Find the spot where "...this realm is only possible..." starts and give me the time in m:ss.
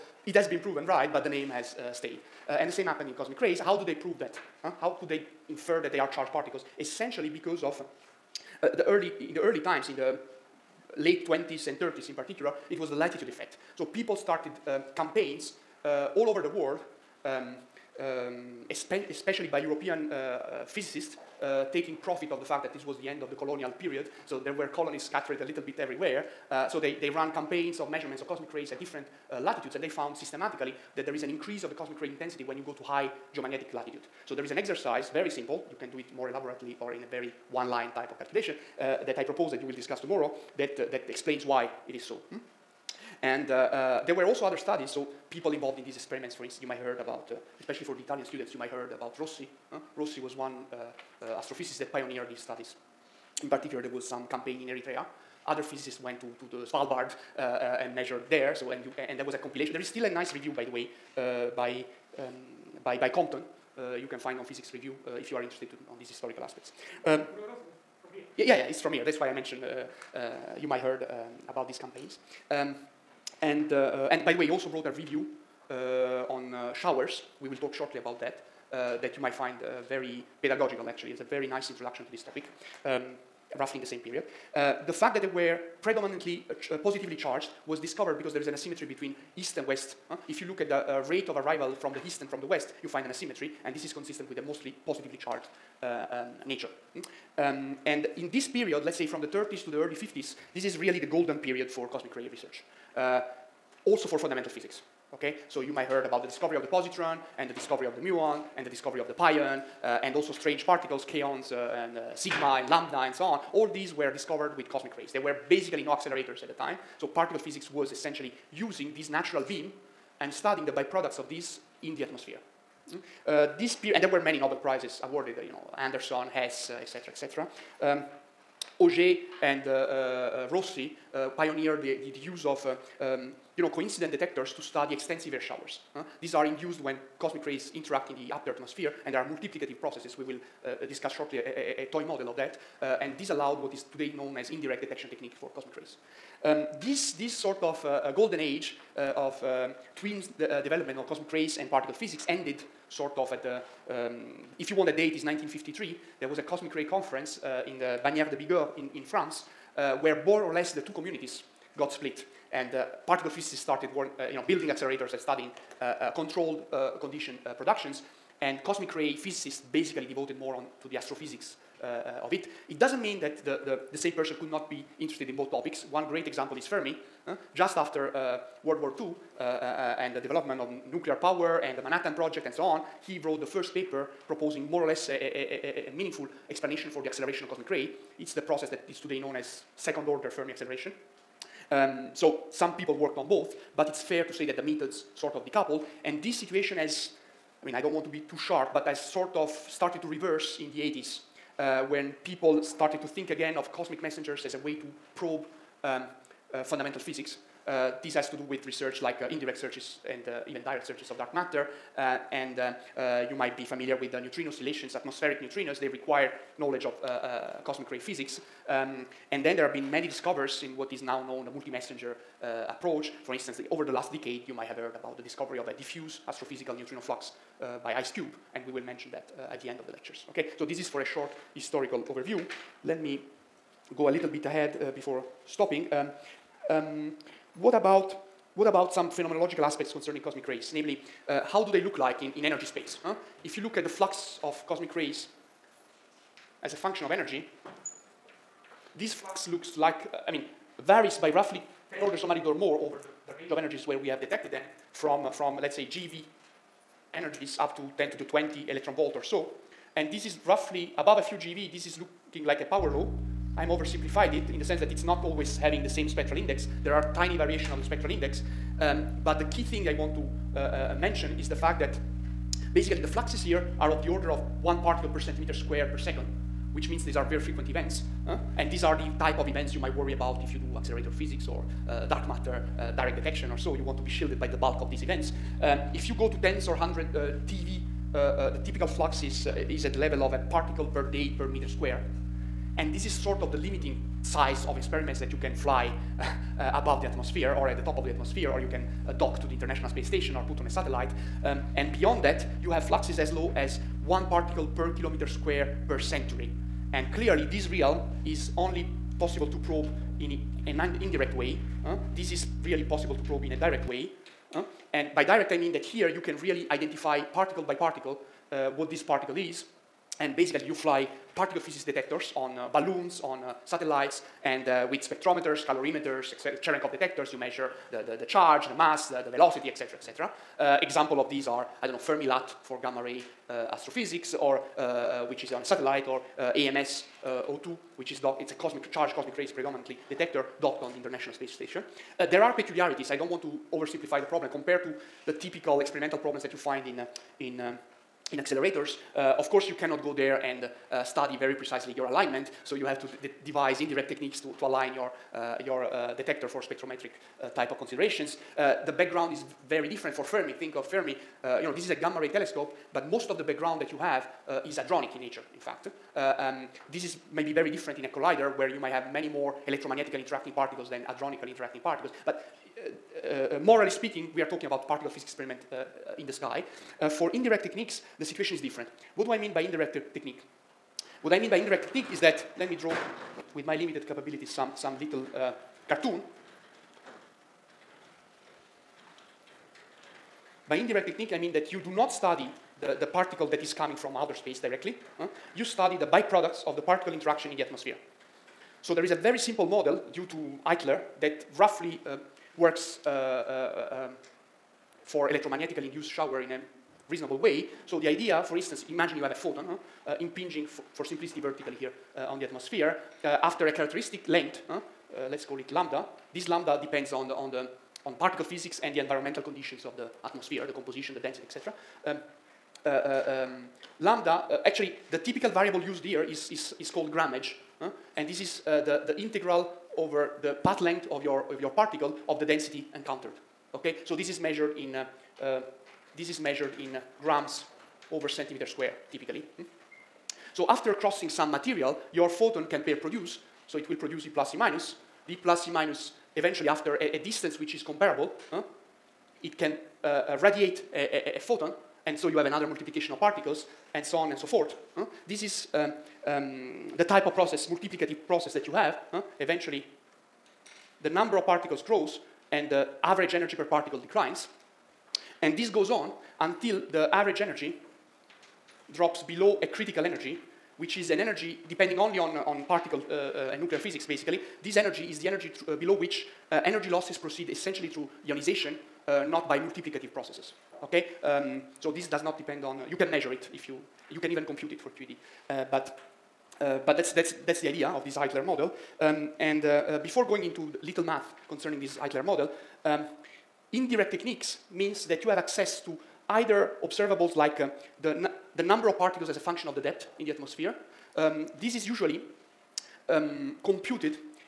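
5:07.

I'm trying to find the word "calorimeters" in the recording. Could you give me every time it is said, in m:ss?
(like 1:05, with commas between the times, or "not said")
5:25.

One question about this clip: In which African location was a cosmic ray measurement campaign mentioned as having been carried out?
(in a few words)
Eritrea.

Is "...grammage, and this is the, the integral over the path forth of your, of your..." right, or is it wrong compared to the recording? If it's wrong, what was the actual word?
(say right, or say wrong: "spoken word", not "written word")
wrong: "length", not "forth".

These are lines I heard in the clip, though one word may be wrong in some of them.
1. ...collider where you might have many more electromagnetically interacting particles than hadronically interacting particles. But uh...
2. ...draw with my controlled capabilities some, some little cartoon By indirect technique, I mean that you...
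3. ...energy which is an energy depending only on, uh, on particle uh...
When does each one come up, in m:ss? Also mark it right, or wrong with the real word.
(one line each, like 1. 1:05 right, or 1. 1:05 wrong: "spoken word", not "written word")
1. 6:08 right
2. 6:22 wrong: "limited", not "controlled"
3. 7:50 right.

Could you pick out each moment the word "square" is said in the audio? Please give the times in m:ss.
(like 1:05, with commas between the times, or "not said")
4:35, 4:51, 5:05, 7:18.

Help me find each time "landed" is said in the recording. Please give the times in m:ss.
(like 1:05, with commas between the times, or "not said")
not said.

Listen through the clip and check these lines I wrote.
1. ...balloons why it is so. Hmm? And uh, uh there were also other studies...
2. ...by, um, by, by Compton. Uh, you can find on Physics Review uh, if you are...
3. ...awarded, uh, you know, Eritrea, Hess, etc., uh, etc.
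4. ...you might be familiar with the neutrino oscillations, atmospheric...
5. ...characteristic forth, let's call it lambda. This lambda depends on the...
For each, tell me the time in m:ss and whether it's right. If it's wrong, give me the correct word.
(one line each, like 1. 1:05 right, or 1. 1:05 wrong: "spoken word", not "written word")
1. 0:41 wrong: "explains", not "balloons"
2. 1:01 right
3. 2:05 wrong: "Anderson", not "Eritrea"
4. 3:33 right
5. 6:53 wrong: "length", not "forth".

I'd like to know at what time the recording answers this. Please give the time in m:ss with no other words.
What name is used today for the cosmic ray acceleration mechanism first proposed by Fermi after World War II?
3:09.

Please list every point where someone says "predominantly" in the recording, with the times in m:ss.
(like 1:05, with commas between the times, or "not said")
1:25, 5:39.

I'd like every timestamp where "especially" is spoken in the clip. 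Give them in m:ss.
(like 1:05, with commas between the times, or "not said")
0:18, 0:47.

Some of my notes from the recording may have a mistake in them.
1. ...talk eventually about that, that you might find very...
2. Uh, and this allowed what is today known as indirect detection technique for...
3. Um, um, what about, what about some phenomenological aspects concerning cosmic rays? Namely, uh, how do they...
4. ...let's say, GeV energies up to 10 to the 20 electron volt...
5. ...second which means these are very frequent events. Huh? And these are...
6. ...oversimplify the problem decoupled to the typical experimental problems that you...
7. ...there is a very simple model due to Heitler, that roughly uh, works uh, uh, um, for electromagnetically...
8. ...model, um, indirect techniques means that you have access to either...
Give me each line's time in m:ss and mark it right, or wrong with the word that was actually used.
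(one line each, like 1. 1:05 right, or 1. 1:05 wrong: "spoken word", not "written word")
1. 1:17 wrong: "shortly", not "eventually"
2. 2:22 right
3. 3:55 right
4. 4:15 right
5. 4:35 right
6. 5:43 wrong: "compared", not "decoupled"
7. 6:38 right
8. 8:12 right.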